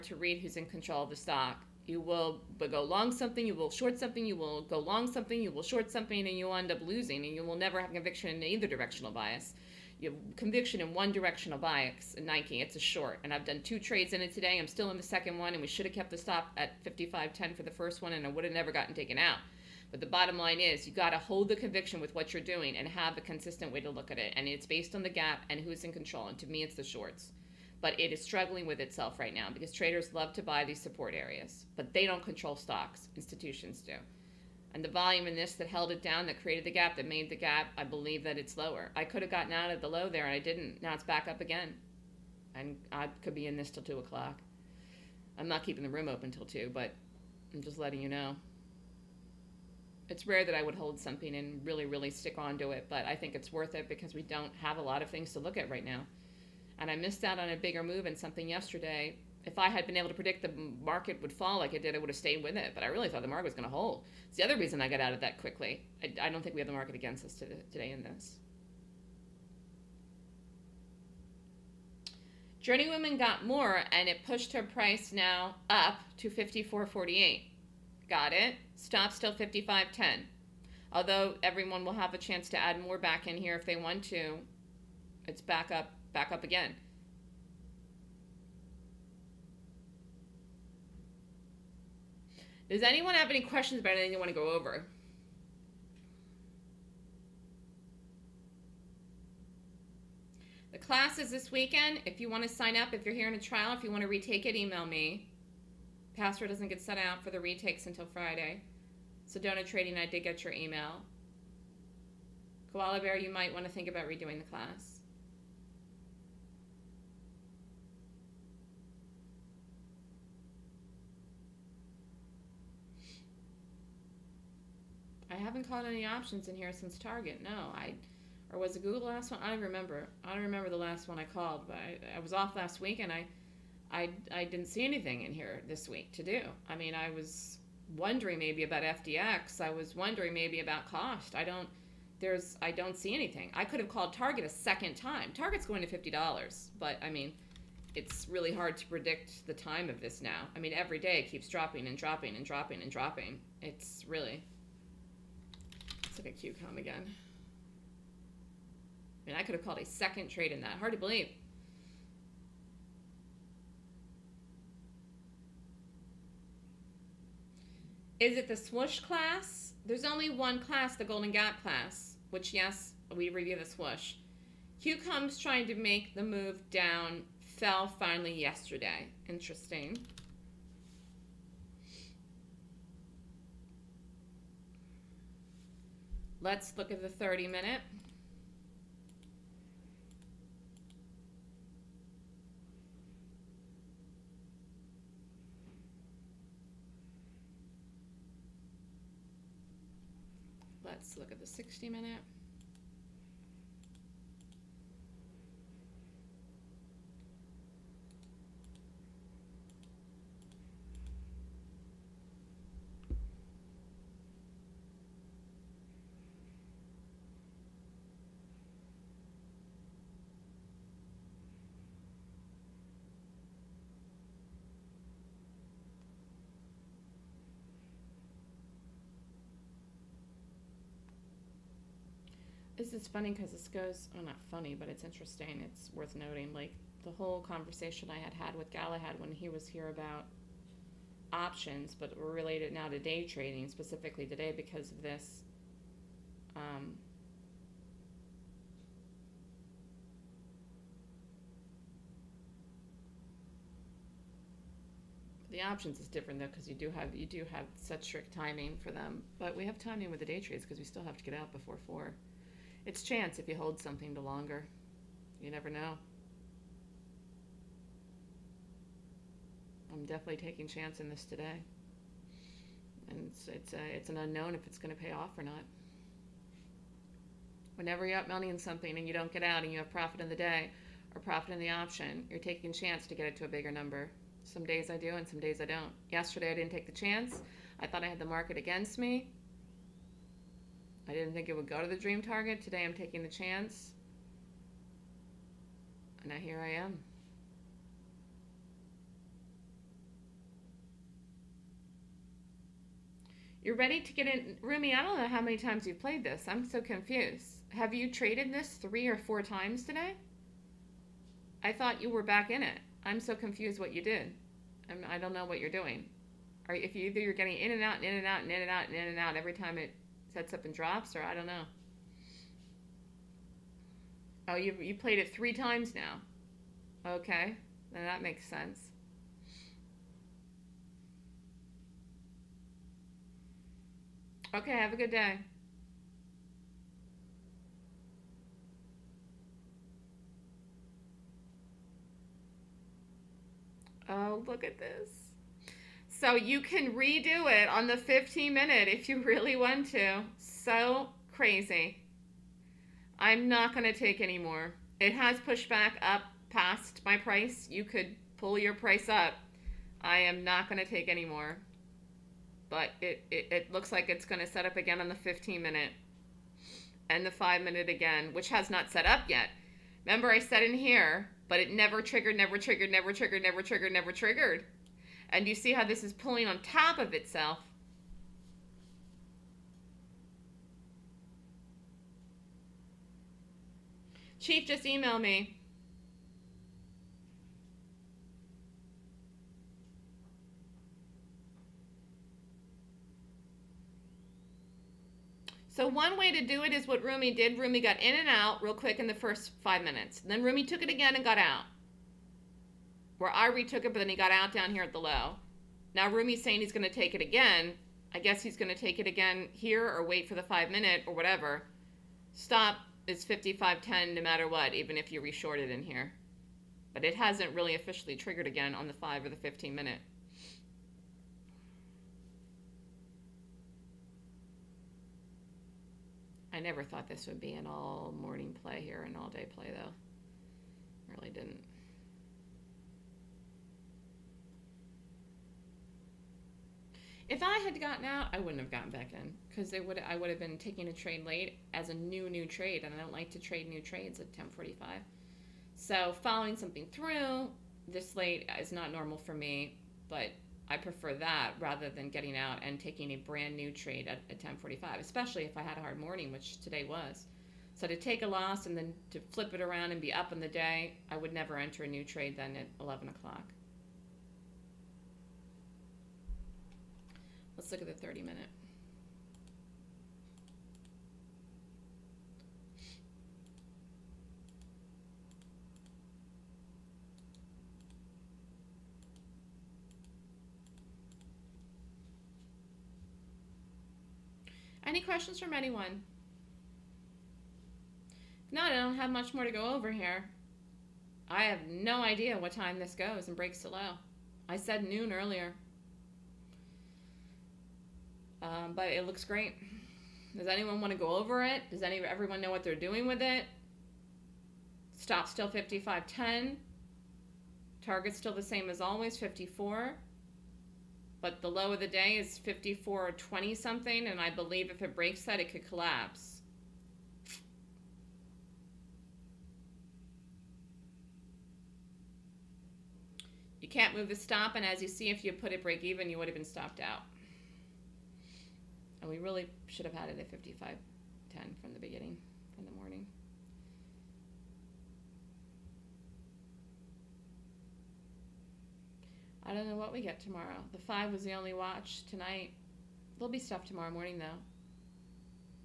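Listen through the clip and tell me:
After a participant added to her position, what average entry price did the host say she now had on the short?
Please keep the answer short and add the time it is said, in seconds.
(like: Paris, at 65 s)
54.48, at 76 s.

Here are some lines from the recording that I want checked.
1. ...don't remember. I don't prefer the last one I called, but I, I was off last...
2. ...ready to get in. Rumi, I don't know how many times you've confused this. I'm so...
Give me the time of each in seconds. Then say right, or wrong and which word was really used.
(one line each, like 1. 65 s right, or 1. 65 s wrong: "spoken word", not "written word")
1. 129 s wrong: "remember", not "prefer"
2. 303 s wrong: "played", not "confused".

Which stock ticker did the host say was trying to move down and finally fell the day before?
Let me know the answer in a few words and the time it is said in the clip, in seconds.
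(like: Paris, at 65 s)
QCOM, at 174 s.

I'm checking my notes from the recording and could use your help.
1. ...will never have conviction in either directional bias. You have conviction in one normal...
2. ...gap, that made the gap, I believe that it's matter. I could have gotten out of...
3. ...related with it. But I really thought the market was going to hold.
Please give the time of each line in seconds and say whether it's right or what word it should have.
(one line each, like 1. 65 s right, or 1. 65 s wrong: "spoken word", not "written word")
1. 7 s wrong: "directional", not "normal"
2. 36 s wrong: "lower", not "matter"
3. 62 s wrong: "stayed", not "related".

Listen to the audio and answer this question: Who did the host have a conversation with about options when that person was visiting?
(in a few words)
Galahad.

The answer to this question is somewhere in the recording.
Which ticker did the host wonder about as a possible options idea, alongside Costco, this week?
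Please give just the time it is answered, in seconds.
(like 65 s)
138 s.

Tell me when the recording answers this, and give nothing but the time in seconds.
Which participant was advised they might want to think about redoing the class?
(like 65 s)
112 s.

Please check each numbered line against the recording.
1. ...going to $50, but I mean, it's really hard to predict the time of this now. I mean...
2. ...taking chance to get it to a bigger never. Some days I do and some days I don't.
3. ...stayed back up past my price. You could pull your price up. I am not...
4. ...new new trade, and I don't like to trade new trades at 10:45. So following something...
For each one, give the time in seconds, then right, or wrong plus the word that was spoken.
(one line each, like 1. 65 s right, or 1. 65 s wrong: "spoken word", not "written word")
1. 145 s right
2. 282 s wrong: "number", not "never"
3. 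355 s wrong: "pushed", not "stayed"
4. 441 s right.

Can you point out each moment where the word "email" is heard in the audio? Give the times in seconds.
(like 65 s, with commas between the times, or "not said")
104 s, 110 s, 384 s.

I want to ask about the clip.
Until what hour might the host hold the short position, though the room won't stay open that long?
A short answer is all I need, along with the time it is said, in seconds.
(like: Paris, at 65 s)
2 o'clock, at 43 s.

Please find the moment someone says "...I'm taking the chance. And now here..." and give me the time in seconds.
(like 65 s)
292 s.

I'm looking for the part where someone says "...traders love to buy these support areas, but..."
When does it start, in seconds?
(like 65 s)
29 s.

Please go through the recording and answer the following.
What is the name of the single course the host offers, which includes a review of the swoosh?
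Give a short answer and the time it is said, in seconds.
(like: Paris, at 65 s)
Golden Gap class, at 170 s.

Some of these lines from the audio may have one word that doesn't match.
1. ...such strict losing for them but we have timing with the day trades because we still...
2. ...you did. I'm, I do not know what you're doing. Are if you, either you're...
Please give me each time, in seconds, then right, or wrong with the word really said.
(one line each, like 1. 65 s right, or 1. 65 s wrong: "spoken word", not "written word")
1. 257 s wrong: "timing", not "losing"
2. 313 s right.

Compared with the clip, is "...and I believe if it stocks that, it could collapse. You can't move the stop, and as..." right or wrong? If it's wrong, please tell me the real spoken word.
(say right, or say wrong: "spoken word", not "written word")
wrong: "breaks", not "stocks".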